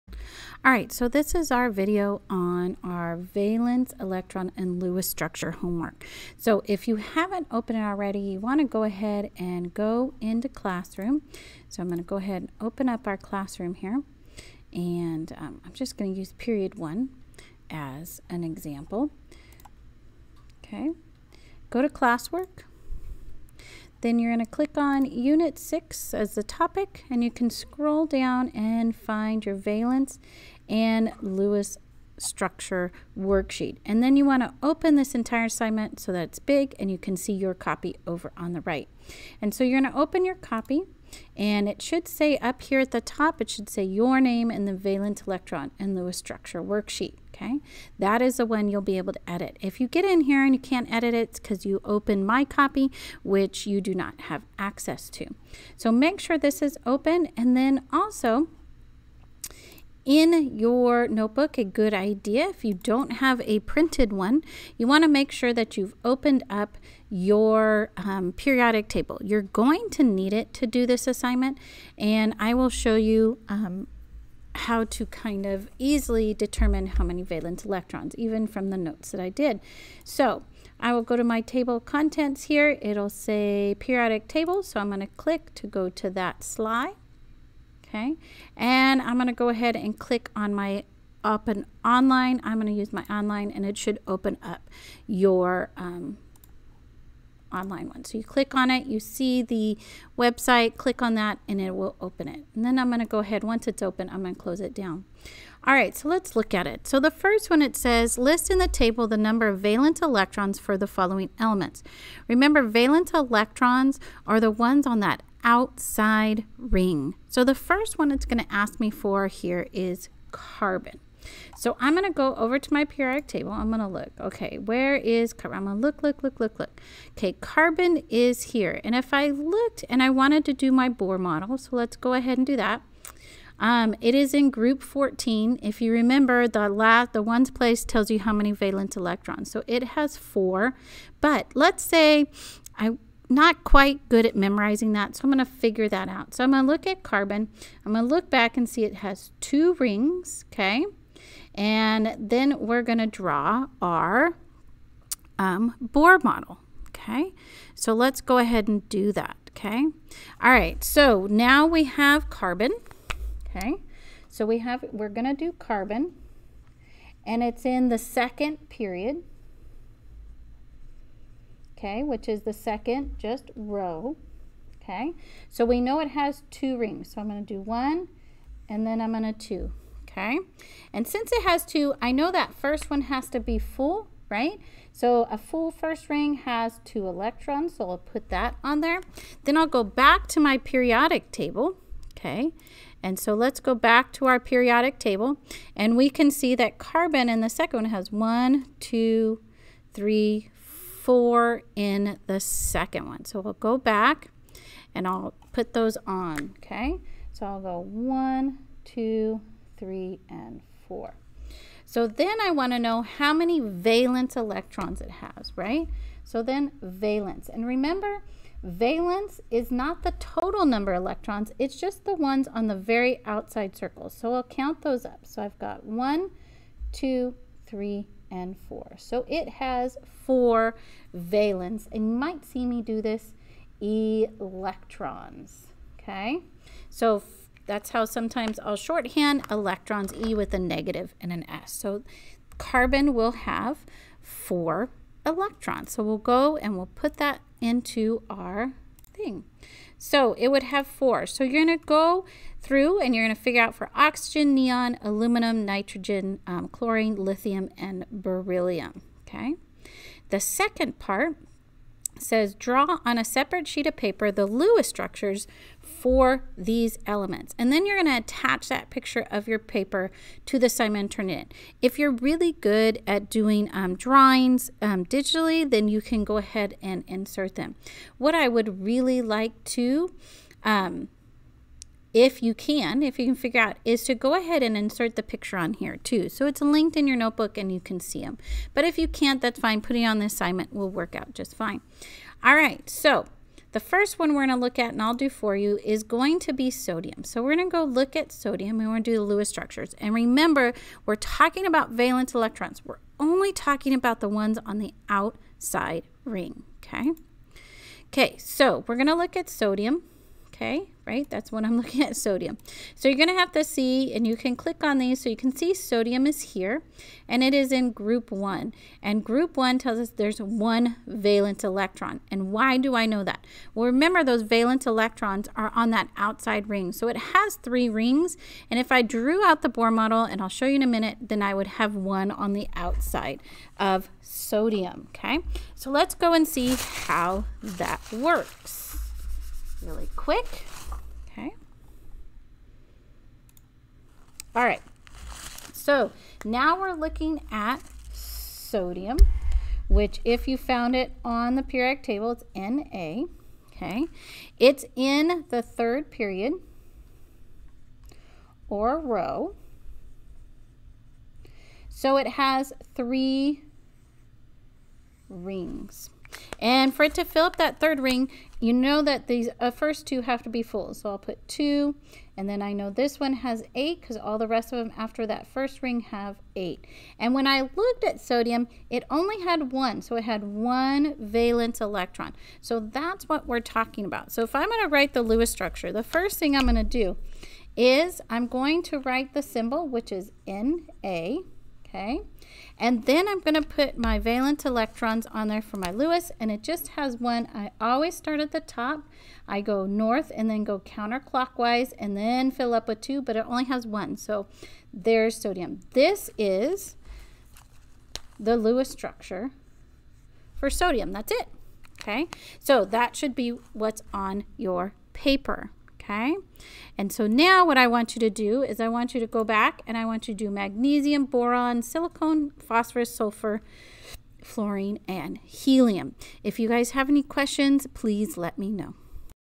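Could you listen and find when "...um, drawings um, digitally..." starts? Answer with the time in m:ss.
4:33.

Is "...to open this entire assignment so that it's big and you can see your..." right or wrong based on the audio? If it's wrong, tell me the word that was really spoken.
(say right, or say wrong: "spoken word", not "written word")
right.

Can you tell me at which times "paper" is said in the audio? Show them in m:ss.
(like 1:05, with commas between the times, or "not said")
4:23, 4:29, 6:55.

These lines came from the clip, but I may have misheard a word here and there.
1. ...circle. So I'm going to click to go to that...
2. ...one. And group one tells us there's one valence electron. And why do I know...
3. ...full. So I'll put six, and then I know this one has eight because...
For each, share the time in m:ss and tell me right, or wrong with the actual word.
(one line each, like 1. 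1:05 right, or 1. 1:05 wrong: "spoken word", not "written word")
1. 1:24 wrong: "table", not "circle"
2. 5:18 right
3. 6:10 wrong: "two", not "six".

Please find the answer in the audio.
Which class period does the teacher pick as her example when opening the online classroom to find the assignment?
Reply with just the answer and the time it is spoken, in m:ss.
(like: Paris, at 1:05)
period one, at 0:16.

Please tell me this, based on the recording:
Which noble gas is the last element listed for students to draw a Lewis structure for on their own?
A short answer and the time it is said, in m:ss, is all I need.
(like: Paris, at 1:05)
helium, at 7:05.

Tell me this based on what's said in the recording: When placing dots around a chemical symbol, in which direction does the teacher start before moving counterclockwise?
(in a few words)
north.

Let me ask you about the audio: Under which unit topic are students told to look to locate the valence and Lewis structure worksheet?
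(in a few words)
Unit 6.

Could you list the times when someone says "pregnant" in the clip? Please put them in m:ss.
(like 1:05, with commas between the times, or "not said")
not said.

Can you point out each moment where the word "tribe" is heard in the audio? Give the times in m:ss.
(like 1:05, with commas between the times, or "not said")
not said.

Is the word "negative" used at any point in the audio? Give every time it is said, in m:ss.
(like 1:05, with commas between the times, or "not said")
4:00.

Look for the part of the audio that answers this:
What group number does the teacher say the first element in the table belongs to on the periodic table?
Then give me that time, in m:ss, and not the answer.
2:14.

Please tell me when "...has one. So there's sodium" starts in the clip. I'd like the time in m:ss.
6:43.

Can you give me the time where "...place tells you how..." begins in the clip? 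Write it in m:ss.
2:17.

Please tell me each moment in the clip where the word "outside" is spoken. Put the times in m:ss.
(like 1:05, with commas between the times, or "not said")
1:55, 3:43, 5:05, 5:26, 5:32.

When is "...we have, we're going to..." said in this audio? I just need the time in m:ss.
2:44.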